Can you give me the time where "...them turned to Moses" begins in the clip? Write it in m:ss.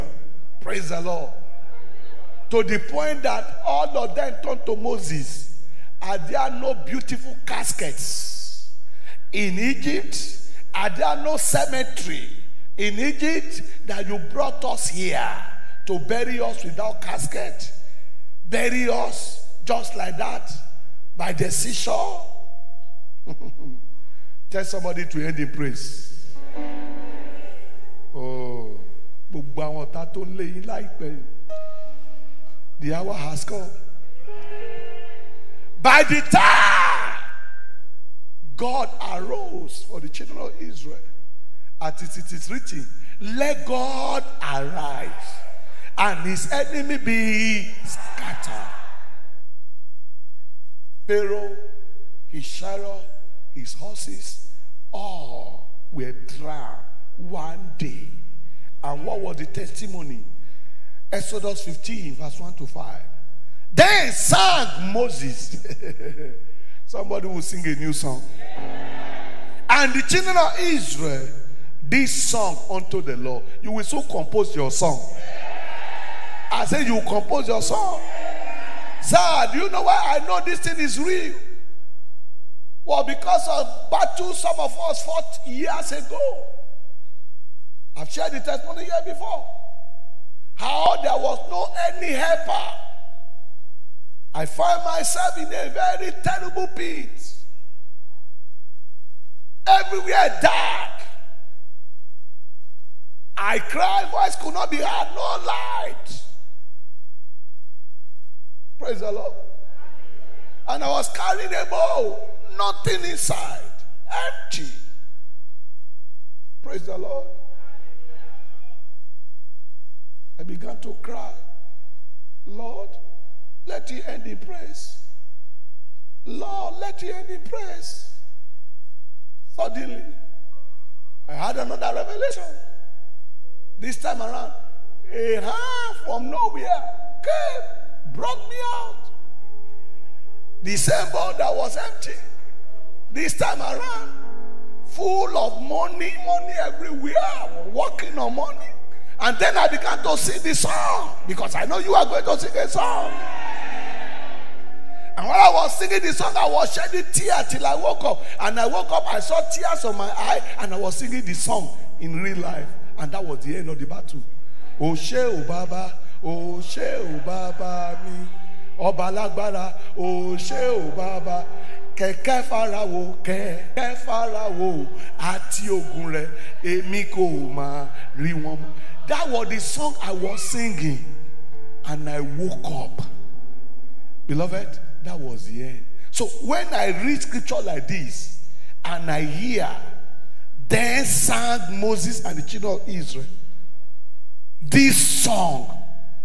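0:04.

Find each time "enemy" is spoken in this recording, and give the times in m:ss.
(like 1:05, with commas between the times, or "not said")
0:46.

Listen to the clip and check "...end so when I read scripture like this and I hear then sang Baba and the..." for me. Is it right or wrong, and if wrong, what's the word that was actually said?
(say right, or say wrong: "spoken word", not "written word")
wrong: "Moses", not "Baba".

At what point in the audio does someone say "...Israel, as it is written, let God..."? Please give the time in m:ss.
0:40.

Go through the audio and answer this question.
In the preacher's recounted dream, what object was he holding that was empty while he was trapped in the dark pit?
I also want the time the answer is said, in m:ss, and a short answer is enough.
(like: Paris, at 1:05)
A bowl, at 1:51.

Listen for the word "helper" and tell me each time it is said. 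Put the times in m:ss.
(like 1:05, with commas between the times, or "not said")
1:32.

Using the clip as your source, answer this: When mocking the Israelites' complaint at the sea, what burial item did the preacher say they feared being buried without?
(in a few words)
Casket.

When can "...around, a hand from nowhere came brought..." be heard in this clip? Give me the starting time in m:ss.
2:14.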